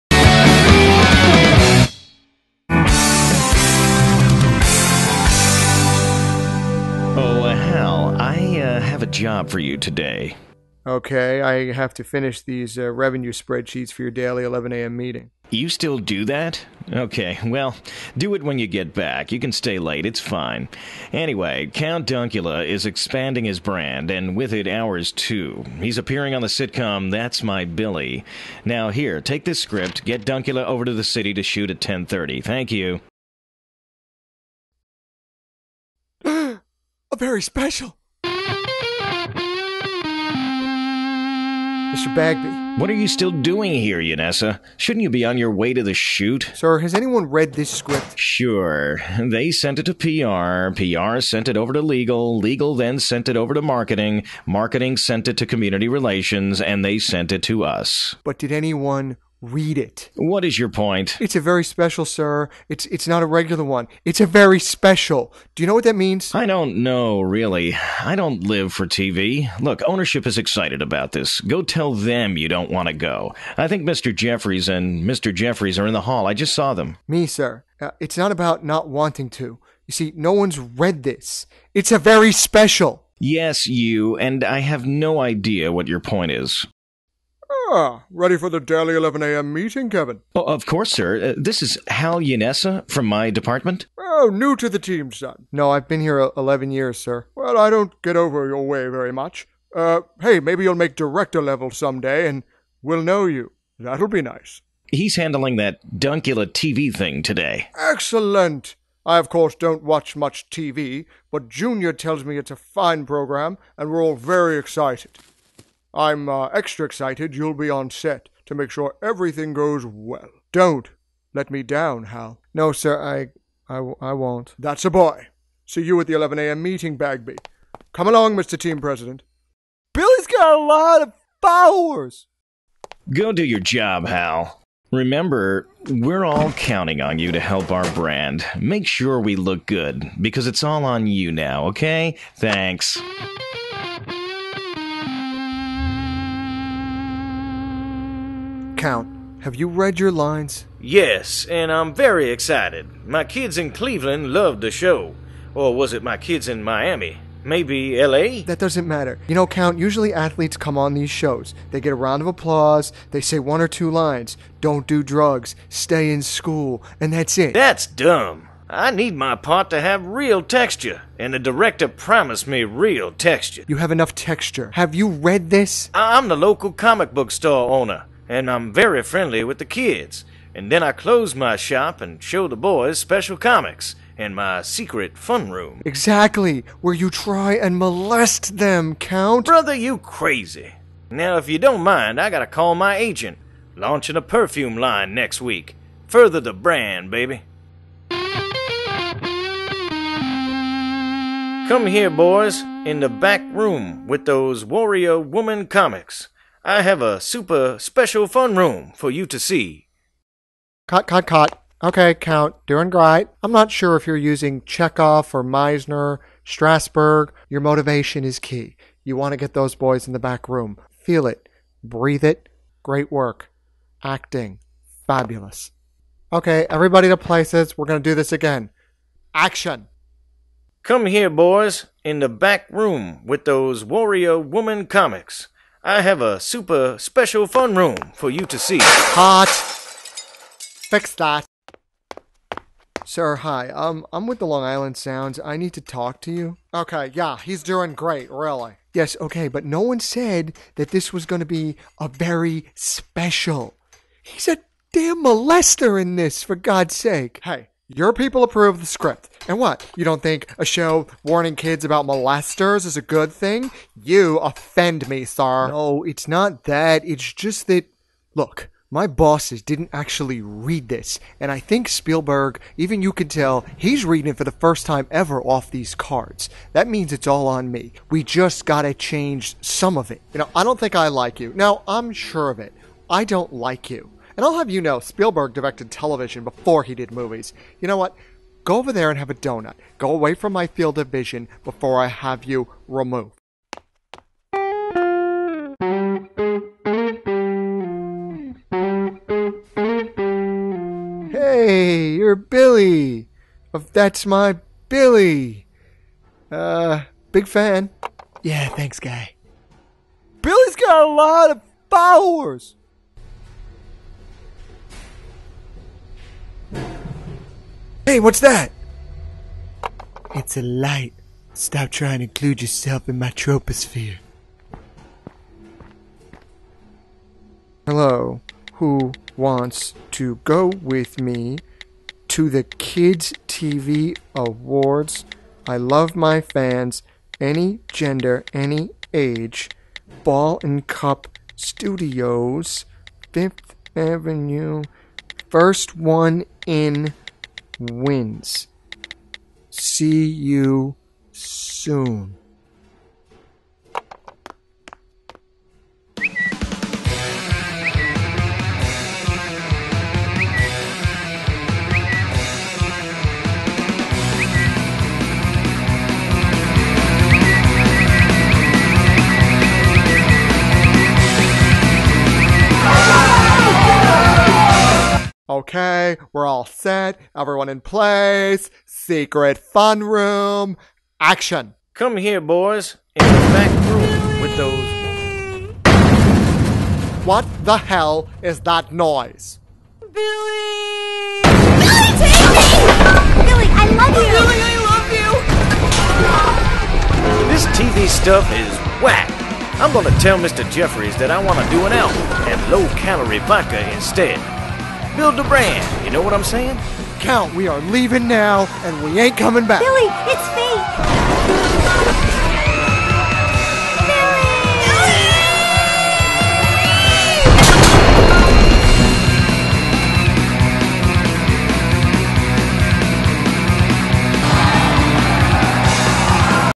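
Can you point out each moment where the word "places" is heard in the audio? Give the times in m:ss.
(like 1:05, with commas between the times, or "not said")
3:47, 6:17.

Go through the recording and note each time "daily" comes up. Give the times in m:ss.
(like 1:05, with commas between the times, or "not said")
0:14, 1:28.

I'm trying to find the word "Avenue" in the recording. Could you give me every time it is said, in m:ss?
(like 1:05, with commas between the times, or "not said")
5:43.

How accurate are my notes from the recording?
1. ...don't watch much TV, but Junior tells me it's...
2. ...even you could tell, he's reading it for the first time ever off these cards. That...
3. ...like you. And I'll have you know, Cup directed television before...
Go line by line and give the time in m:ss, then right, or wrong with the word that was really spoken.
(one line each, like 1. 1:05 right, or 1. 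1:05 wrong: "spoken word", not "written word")
1. 1:49 right
2. 4:32 right
3. 4:43 wrong: "Spielberg", not "Cup".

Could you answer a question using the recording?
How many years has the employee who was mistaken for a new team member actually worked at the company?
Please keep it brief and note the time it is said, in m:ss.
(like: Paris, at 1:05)
11, at 1:36.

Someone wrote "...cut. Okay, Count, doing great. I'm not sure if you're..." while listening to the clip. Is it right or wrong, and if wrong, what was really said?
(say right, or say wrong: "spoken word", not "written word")
right.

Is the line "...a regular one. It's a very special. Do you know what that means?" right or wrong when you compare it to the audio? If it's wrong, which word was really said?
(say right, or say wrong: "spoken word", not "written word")
right.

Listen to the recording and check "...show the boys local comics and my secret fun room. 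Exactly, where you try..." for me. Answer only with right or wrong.
wrong.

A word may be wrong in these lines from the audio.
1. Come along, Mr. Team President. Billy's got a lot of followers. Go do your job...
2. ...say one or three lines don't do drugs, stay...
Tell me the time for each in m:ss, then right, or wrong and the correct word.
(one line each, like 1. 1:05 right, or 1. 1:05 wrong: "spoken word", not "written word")
1. 2:07 right
2. 2:43 wrong: "two", not "three".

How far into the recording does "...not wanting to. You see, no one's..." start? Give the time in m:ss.
1:18.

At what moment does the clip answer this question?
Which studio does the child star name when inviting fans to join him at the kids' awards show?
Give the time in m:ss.
5:40.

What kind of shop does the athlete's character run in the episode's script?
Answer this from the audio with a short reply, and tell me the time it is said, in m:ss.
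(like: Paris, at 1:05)
comic book store, at 2:56.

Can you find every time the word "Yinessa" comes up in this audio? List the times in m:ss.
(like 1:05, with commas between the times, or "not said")
0:43, 1:32.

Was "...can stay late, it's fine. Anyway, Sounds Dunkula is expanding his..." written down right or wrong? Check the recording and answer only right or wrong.
wrong.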